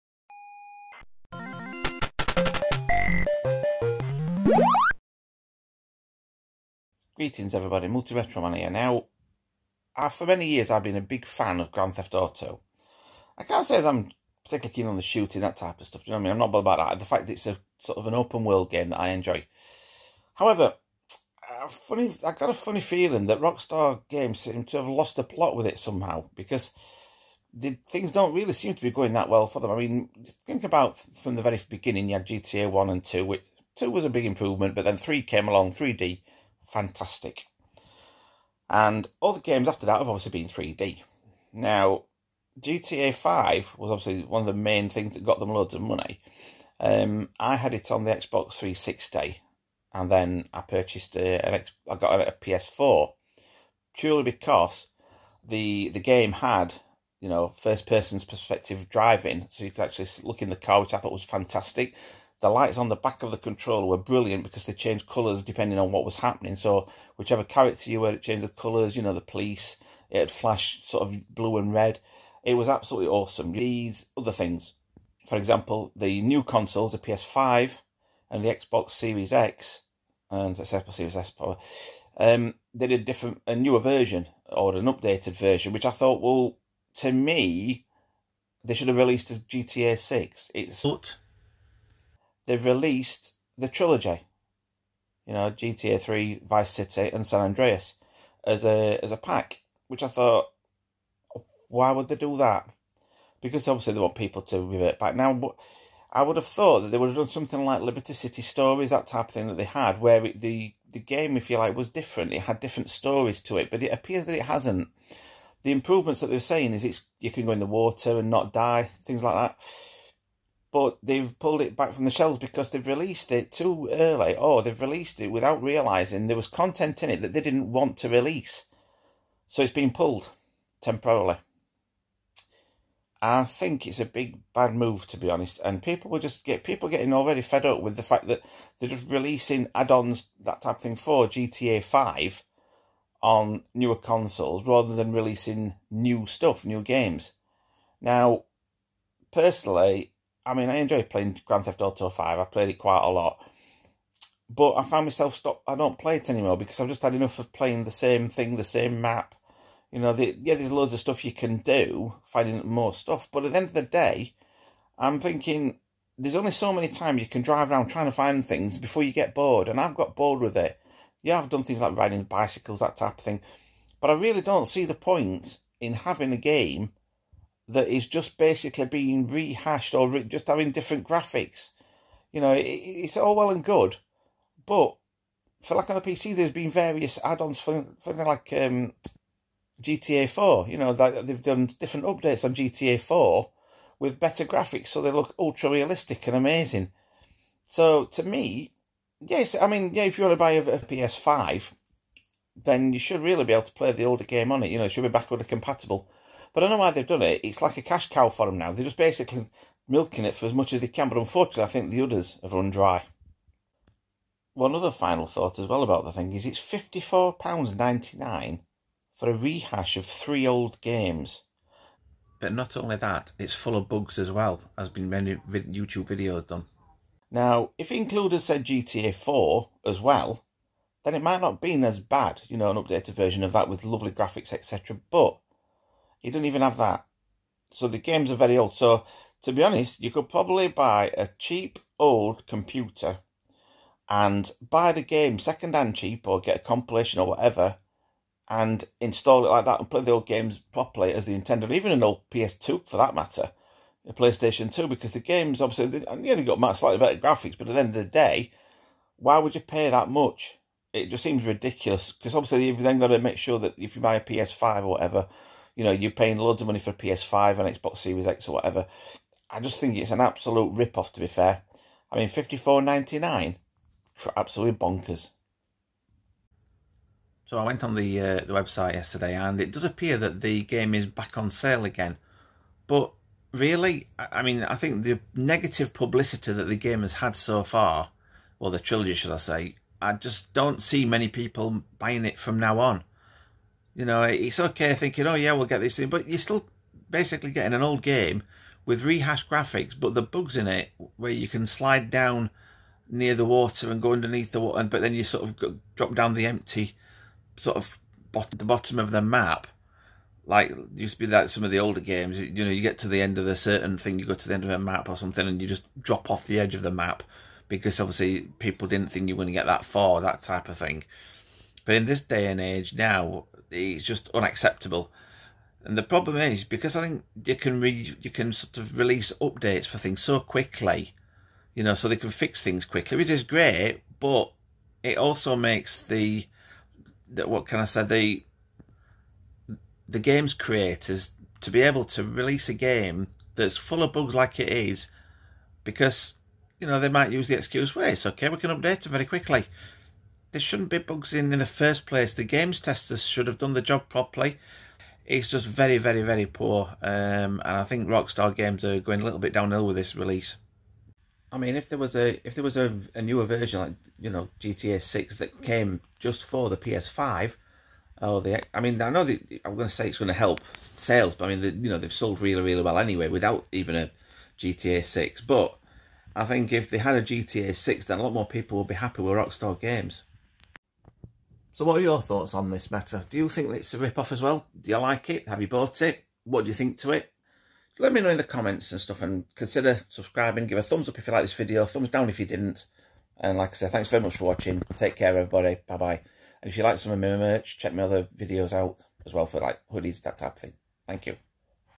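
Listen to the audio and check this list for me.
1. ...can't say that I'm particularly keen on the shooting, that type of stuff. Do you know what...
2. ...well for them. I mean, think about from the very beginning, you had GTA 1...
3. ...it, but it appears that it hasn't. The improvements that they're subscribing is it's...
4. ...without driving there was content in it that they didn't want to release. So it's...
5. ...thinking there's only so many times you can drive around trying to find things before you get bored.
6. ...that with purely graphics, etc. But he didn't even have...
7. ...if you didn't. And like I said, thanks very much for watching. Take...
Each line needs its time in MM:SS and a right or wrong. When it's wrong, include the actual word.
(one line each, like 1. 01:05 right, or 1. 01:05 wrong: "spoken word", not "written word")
1. 00:13 right
2. 00:29 right
3. 01:53 wrong: "saying", not "subscribing"
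4. 02:05 wrong: "realizing", not "driving"
5. 02:45 right
6. 03:53 wrong: "lovely", not "purely"
7. 06:32 right.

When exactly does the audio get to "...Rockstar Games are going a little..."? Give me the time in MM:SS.
05:58.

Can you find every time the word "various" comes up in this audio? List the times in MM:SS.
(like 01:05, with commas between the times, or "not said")
03:06.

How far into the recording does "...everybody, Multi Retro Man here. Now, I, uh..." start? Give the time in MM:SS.
00:07.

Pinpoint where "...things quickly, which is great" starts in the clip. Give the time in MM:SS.
05:32.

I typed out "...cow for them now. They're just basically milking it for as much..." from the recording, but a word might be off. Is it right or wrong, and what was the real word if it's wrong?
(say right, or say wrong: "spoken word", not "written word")
right.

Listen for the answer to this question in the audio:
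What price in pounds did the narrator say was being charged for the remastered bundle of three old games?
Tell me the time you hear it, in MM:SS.
03:36.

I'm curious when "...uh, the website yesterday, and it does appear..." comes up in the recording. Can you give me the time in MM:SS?
04:38.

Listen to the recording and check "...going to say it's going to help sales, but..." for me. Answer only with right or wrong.
right.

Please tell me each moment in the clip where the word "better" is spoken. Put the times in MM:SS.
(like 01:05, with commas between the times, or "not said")
03:14, 04:16.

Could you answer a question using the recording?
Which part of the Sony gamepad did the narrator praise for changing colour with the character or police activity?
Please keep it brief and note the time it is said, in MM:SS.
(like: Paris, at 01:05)
The lights on the back of the controller, at 01:02.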